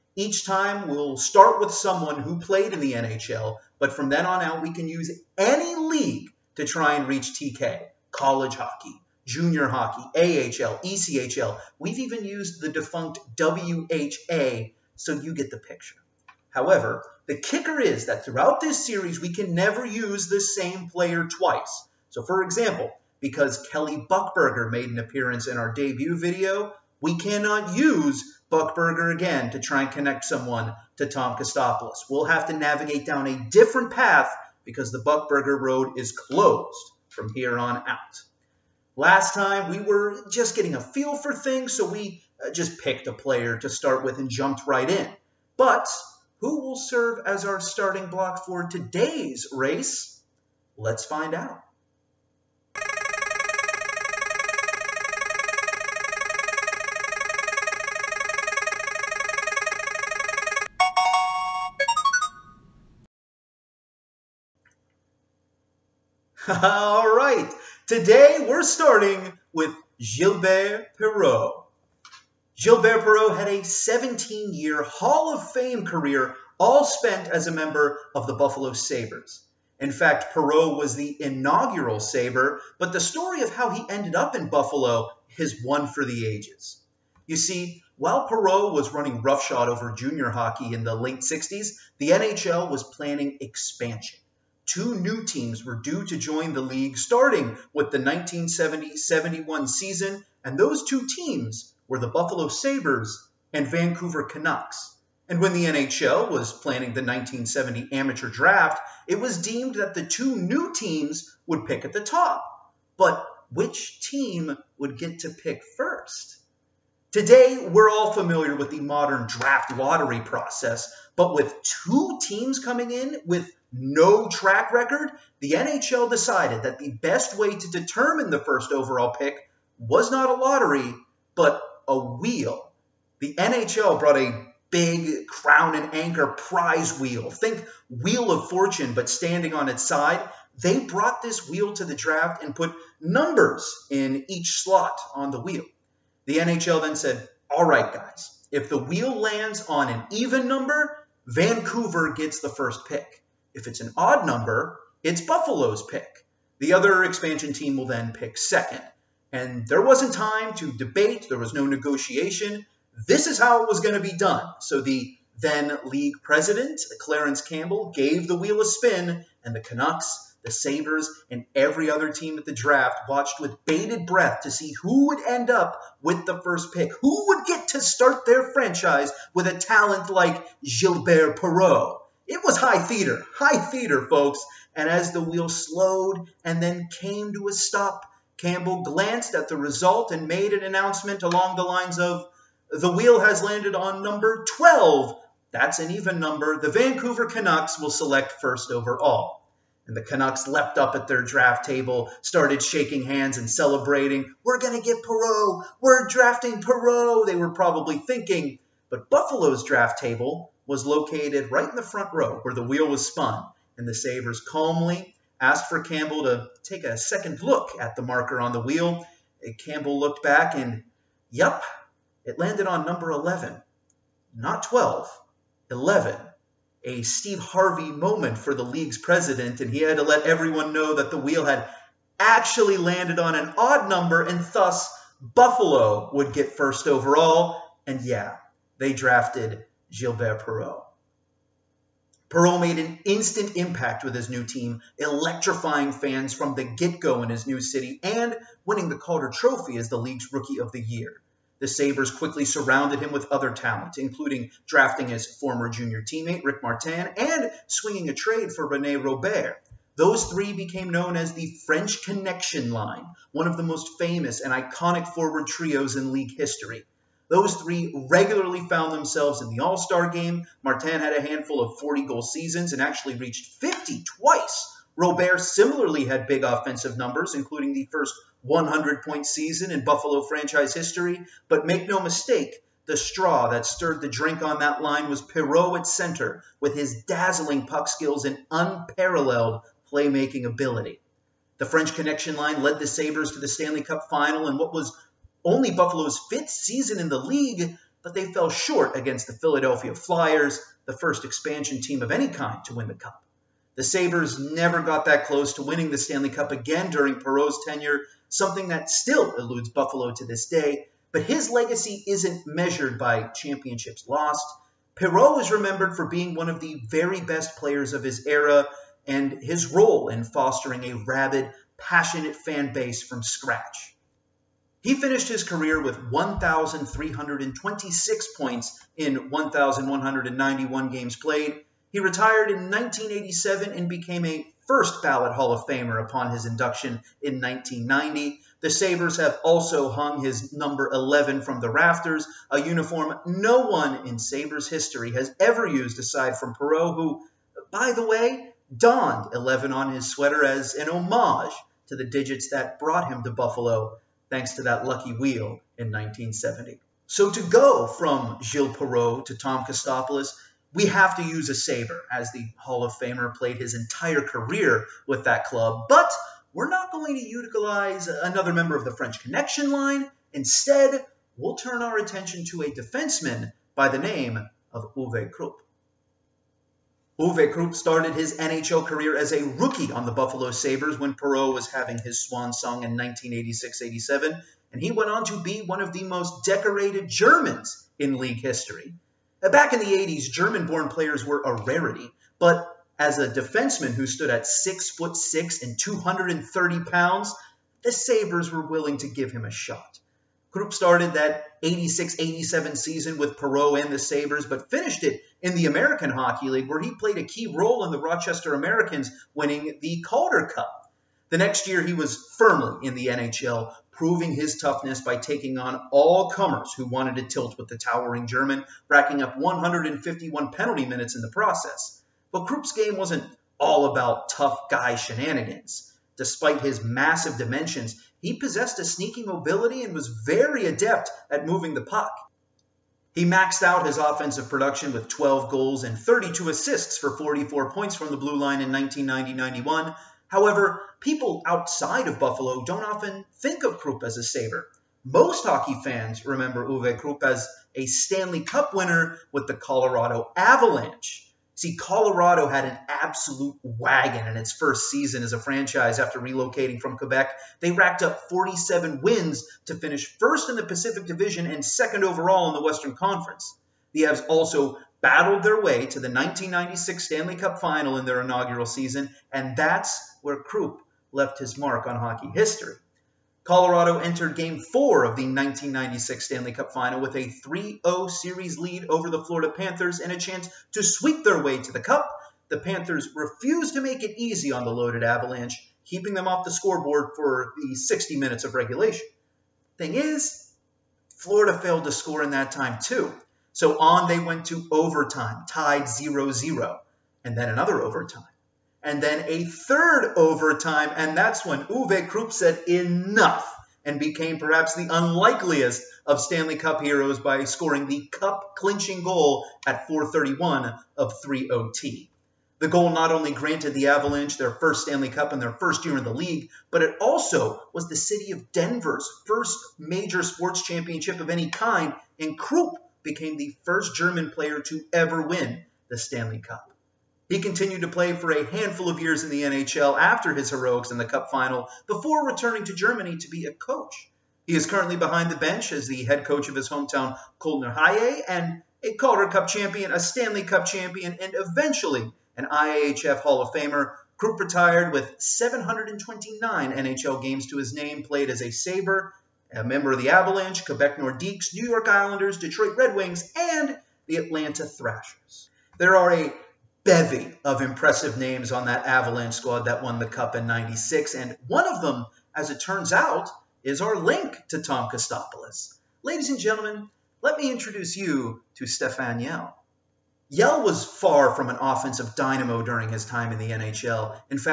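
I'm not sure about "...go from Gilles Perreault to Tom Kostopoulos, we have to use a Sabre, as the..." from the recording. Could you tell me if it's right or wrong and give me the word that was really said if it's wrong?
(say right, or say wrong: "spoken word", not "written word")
right.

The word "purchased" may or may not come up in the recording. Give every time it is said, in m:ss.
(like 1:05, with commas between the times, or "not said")
not said.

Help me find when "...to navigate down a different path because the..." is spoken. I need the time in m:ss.
0:32.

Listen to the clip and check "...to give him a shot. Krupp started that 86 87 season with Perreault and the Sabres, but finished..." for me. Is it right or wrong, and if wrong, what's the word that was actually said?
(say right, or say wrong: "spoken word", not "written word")
right.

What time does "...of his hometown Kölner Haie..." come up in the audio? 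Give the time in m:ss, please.
8:56.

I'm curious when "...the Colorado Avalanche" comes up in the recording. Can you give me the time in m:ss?
7:29.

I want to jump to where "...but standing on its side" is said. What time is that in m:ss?
2:18.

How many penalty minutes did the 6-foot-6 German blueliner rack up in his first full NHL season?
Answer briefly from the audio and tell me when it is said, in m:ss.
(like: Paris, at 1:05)
151, at 6:59.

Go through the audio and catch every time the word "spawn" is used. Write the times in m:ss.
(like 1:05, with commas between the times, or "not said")
not said.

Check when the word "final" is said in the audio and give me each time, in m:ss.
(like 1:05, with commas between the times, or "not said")
4:54, 7:47, 7:56, 8:51.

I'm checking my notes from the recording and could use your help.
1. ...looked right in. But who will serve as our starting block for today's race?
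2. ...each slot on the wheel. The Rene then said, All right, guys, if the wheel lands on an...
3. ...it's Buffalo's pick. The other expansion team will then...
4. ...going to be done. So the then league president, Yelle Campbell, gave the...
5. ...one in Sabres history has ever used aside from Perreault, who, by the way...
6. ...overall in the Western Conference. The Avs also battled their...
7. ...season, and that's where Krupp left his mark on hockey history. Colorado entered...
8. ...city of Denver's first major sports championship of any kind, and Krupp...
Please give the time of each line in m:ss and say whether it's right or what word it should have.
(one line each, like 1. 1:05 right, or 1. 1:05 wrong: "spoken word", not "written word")
1. 0:44 wrong: "jumped", not "looked"
2. 2:24 wrong: "NHL", not "Rene"
3. 2:35 right
4. 2:43 wrong: "Clarence", not "Yelle"
5. 5:43 right
6. 7:42 right
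7. 7:48 right
8. 8:37 right.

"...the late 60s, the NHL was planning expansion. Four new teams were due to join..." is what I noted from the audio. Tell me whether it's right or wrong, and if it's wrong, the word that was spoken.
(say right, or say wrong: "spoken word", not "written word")
wrong: "Two", not "Four".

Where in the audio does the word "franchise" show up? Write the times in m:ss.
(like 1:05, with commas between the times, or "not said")
2:58, 4:40, 7:35.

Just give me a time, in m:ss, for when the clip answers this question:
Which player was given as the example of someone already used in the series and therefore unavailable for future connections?
0:23.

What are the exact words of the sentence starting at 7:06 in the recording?
Despite his massive dimensions, he possessed a sneaky mobility and was very adept at moving the puck.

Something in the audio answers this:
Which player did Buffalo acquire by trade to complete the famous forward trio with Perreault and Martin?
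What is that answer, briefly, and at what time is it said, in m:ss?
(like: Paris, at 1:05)
Rene Robert, at 4:18.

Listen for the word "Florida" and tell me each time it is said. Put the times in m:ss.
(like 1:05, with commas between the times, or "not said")
7:59, 8:11.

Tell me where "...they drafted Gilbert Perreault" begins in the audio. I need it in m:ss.
3:58.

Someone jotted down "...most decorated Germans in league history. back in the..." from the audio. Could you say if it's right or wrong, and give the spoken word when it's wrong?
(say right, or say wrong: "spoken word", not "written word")
right.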